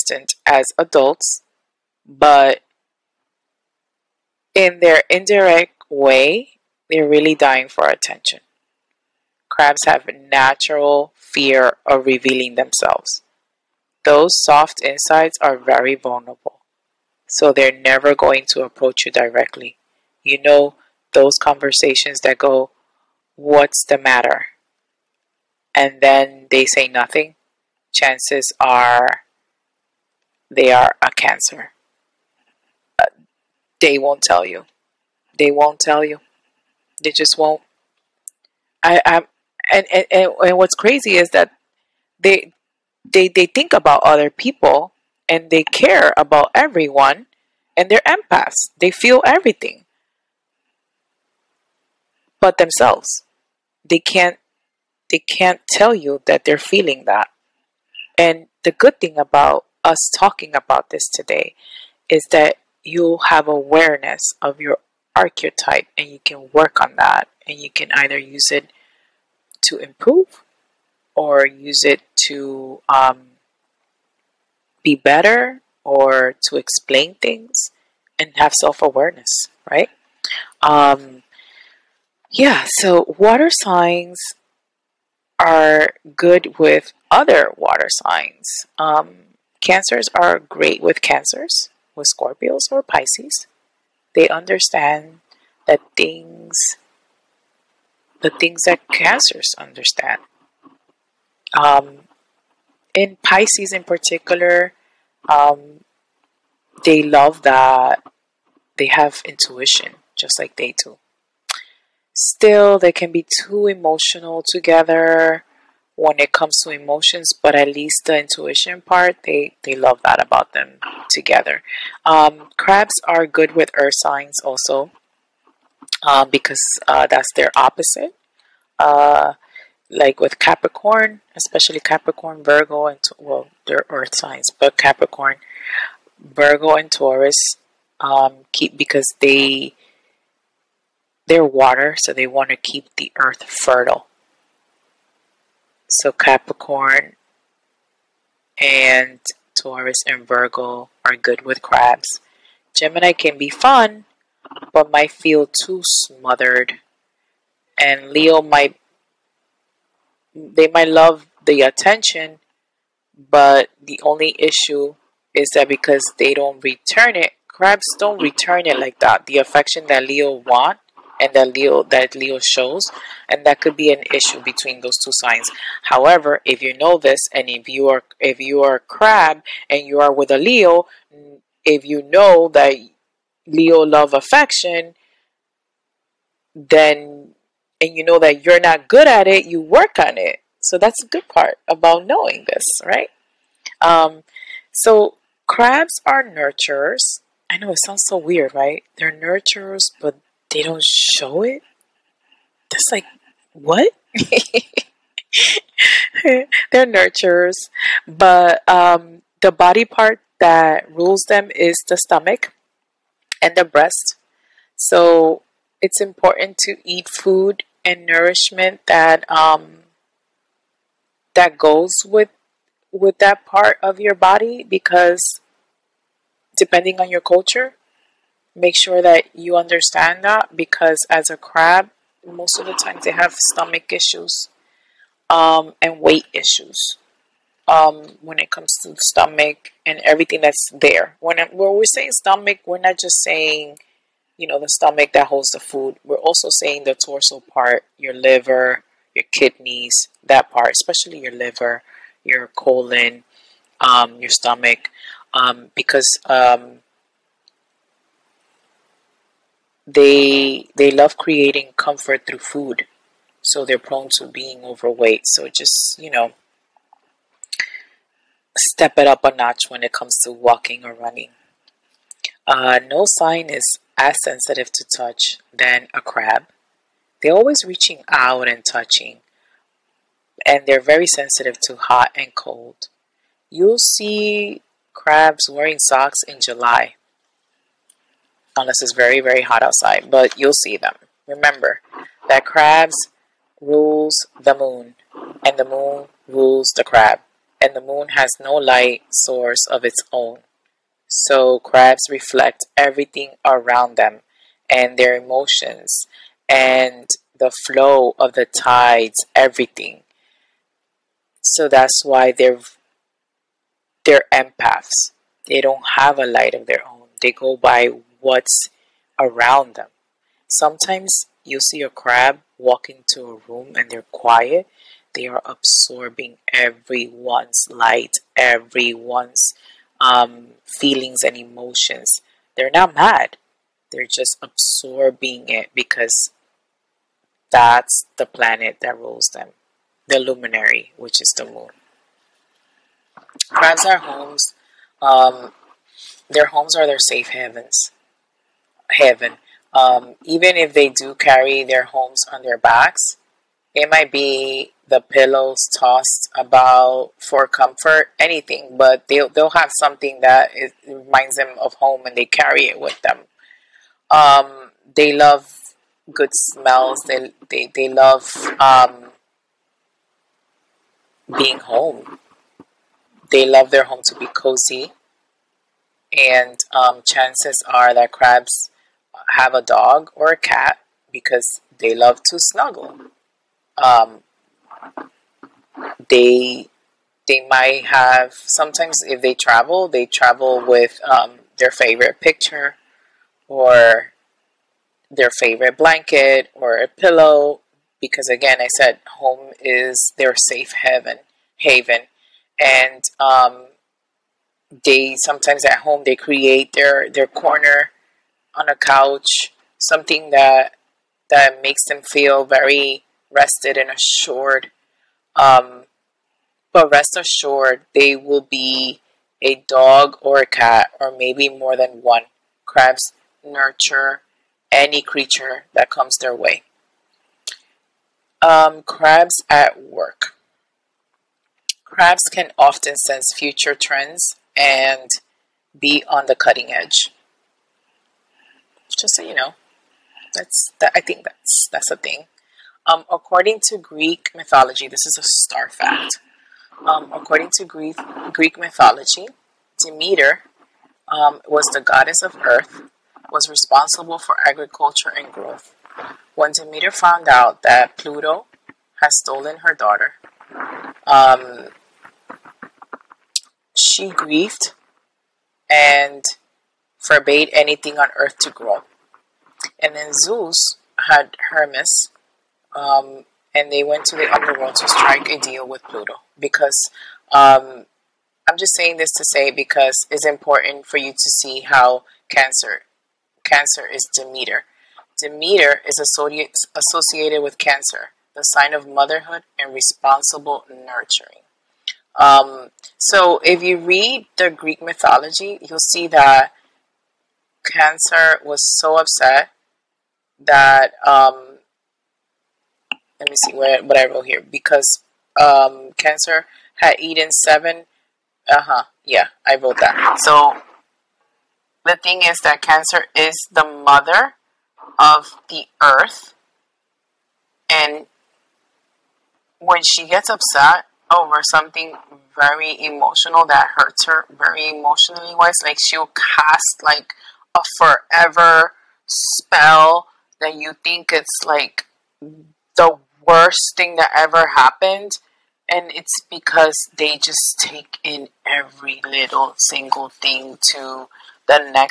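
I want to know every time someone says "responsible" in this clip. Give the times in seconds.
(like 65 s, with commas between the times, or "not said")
453 s, 489 s.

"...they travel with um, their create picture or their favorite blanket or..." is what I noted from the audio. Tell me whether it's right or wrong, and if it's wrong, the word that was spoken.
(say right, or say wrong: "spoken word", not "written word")
wrong: "favorite", not "create".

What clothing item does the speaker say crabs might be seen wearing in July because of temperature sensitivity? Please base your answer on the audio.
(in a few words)
socks.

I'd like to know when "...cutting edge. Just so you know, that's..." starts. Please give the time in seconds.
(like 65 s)
436 s.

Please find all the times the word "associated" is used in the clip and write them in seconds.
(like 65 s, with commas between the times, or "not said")
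486 s.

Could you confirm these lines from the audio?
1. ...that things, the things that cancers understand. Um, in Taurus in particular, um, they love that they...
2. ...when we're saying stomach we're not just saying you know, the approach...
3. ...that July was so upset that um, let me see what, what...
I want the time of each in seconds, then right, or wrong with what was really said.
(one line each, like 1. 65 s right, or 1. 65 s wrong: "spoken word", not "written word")
1. 95 s wrong: "Pisces", not "Taurus"
2. 241 s wrong: "stomach", not "approach"
3. 496 s wrong: "Cancer", not "July".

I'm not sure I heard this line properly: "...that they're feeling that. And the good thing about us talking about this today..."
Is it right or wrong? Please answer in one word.
right.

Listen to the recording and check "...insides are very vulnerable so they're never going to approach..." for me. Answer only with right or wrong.
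right.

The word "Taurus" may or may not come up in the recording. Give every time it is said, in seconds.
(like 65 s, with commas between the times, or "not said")
136 s, 149 s.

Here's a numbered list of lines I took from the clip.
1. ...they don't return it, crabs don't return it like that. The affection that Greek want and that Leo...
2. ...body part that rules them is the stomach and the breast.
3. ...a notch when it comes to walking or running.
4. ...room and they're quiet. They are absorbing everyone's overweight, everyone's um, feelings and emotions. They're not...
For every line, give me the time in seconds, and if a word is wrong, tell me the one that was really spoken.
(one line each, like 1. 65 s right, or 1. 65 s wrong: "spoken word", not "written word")
1. 166 s wrong: "Leo", not "Greek"
2. 209 s right
3. 269 s right
4. 323 s wrong: "light", not "overweight".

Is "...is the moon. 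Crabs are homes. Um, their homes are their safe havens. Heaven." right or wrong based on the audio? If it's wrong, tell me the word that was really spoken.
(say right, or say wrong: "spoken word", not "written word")
right.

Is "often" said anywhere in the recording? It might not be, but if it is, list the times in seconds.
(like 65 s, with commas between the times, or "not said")
432 s.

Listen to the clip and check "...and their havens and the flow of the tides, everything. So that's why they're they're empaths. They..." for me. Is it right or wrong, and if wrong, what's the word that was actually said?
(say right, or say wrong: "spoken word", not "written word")
wrong: "emotions", not "havens".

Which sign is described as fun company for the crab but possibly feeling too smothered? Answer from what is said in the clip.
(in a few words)
Gemini.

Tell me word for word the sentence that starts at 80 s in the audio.
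Um, yeah, so water signs are good with other water signs.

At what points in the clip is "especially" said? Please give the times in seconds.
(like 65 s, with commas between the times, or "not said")
131 s, 250 s.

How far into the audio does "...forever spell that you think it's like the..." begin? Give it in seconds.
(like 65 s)
527 s.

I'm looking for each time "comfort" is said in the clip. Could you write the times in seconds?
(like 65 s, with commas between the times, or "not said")
261 s, 357 s.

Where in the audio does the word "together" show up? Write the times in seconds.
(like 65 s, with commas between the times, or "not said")
114 s, 121 s.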